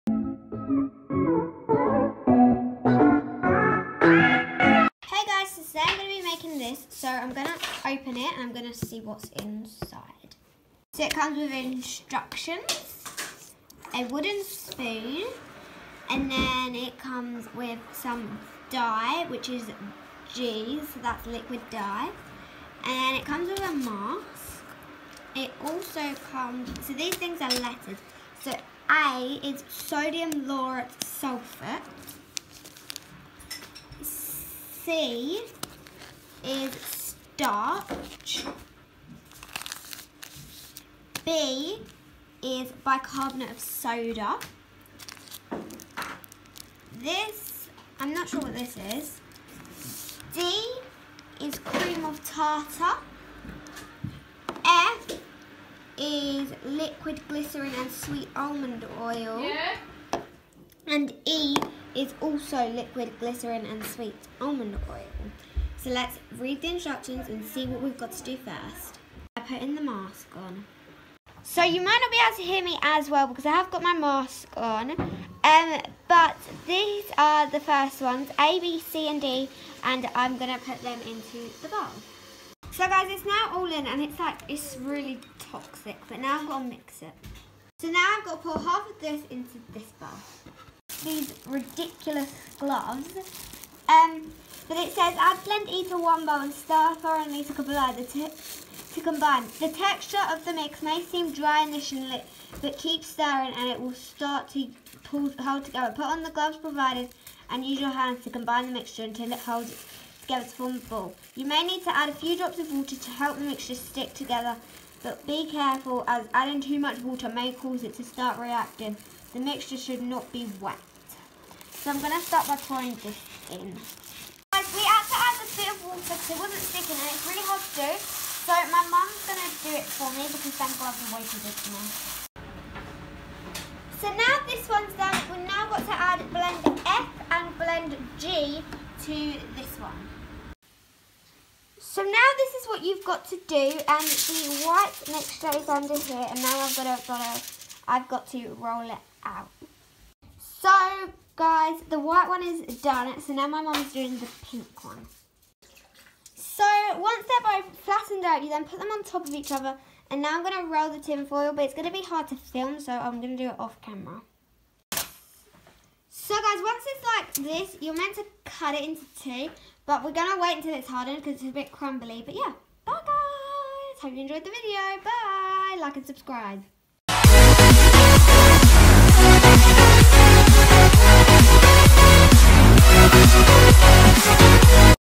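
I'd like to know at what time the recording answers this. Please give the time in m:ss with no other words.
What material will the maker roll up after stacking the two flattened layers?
2:40.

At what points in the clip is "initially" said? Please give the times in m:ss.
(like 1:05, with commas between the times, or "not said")
1:41.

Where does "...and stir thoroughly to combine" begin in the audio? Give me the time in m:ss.
1:36.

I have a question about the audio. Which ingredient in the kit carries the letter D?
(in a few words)
Cream of tartar.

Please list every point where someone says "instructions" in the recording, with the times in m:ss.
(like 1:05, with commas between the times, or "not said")
0:11, 1:06.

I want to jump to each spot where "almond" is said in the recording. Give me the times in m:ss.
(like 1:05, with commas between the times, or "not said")
0:58, 1:04.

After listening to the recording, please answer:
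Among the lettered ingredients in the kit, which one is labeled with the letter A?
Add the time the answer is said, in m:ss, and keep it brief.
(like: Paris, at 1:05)
Sodium lauryl sulfate, at 0:29.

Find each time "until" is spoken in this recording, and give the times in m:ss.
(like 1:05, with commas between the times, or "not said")
1:49, 2:50.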